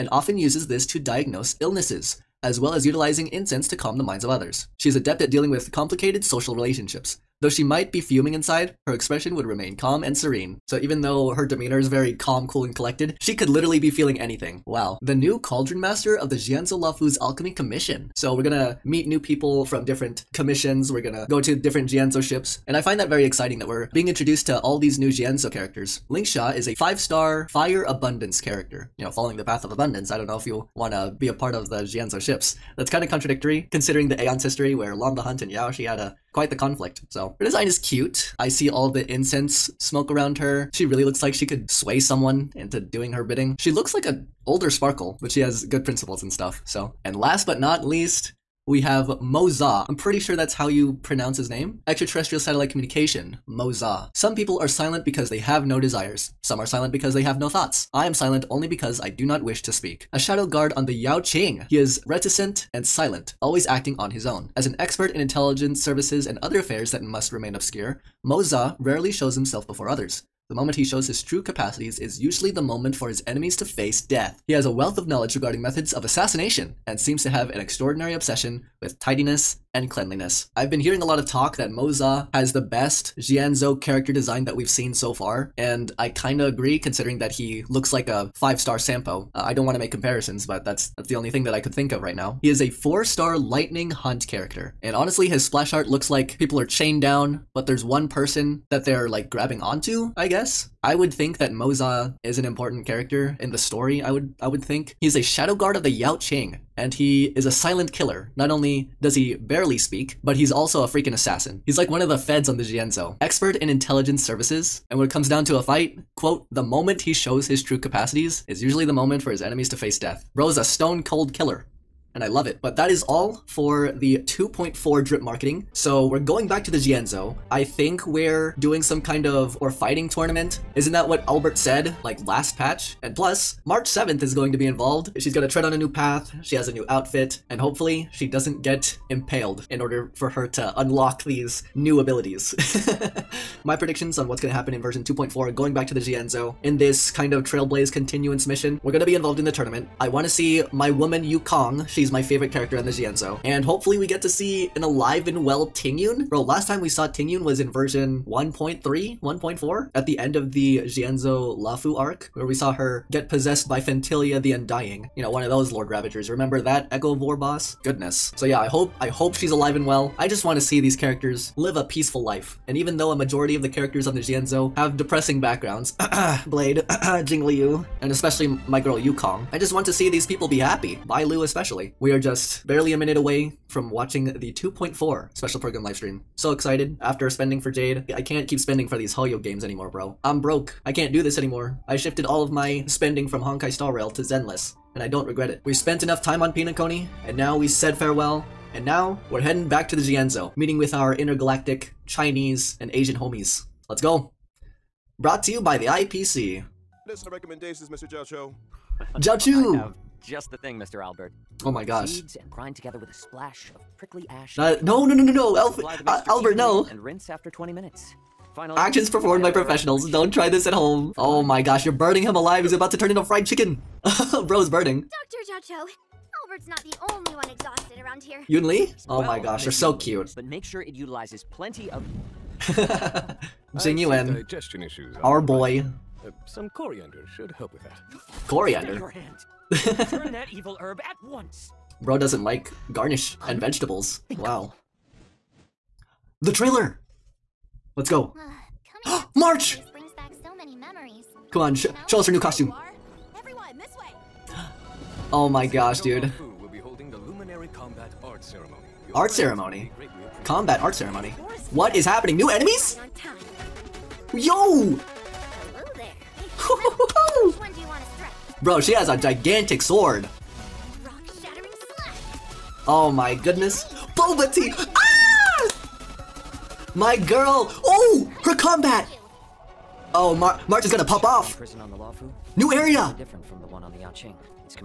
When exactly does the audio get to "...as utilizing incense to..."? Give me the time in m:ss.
0:02.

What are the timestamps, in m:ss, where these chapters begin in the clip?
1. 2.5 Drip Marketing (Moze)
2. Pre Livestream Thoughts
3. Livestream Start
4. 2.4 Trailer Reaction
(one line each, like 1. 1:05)
1. 0:48
2. 2:05
3. 3:23
4. 4:05.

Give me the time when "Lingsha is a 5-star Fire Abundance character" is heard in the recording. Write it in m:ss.
0:26.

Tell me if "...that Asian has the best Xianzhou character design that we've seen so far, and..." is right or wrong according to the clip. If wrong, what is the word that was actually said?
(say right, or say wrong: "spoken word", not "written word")
wrong: "Moze", not "Asian".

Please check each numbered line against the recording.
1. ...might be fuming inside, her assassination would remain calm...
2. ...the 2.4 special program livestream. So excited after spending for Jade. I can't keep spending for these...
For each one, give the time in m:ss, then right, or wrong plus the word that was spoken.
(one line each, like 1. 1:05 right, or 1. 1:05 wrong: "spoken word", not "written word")
1. 0:07 wrong: "expression", not "assassination"
2. 3:04 right.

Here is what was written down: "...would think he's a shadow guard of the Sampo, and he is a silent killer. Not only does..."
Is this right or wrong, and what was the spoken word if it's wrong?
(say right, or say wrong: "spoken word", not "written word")
wrong: "Yaoqing", not "Sampo".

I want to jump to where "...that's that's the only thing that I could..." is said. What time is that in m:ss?
1:30.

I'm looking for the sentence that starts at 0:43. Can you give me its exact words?
She looks like a older Sparkle, but she has good principles and stuff.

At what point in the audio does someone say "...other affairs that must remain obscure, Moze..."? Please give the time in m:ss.
1:06.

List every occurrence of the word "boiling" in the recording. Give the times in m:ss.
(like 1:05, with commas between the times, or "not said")
not said.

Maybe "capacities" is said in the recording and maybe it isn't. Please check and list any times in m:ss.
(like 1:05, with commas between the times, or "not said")
1:11, 1:57.